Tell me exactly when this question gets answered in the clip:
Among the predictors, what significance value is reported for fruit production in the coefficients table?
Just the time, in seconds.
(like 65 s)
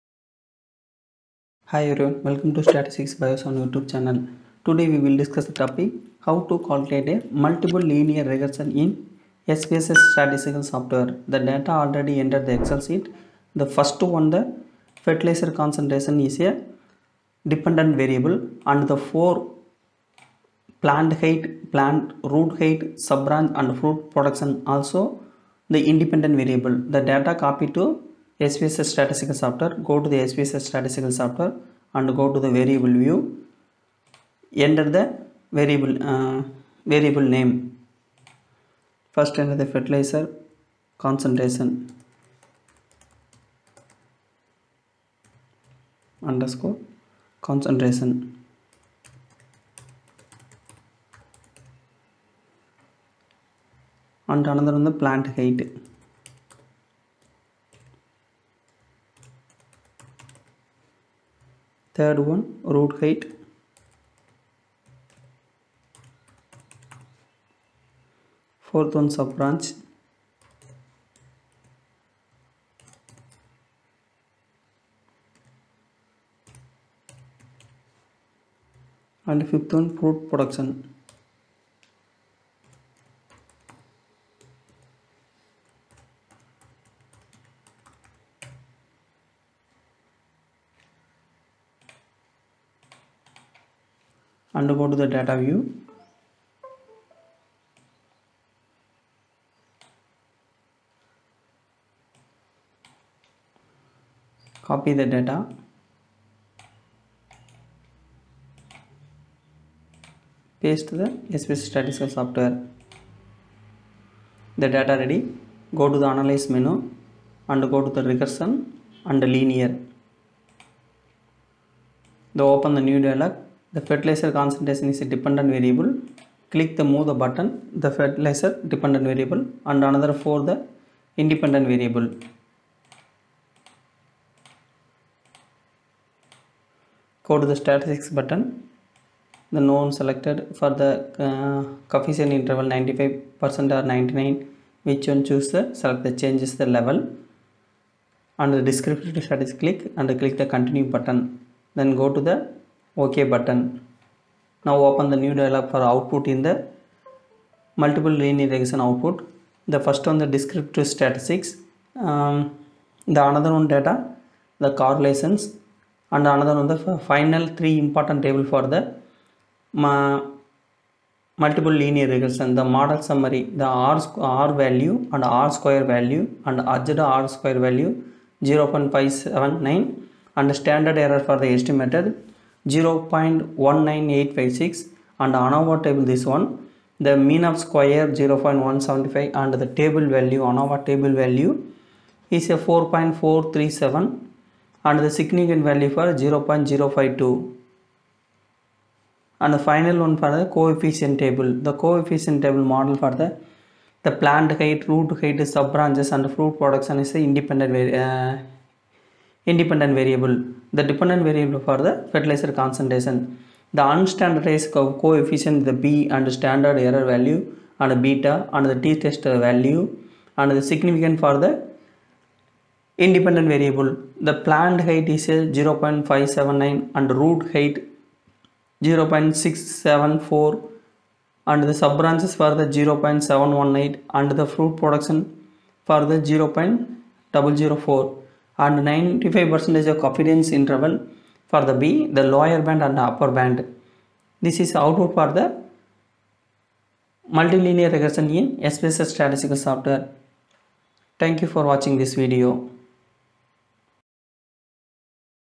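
236 s.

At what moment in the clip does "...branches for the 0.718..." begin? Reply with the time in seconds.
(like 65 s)
231 s.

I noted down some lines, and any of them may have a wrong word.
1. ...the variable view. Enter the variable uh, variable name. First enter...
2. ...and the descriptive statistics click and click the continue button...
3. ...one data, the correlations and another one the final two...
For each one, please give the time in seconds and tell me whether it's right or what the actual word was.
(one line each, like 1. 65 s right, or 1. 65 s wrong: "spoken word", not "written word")
1. 32 s right
2. 148 s right
3. 163 s wrong: "three", not "two".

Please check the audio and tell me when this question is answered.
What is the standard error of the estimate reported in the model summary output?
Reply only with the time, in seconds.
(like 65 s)
182 s.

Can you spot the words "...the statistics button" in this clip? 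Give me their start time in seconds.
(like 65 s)
137 s.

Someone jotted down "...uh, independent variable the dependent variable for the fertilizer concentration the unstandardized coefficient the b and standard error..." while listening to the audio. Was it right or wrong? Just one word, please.
right.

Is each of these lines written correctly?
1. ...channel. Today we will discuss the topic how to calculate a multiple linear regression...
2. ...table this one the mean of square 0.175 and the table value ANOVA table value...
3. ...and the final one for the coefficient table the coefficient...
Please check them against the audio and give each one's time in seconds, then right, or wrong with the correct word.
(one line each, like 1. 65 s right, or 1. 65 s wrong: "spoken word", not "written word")
1. 3 s right
2. 185 s right
3. 199 s right.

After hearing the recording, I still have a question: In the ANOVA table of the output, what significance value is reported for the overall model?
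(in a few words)
0.052.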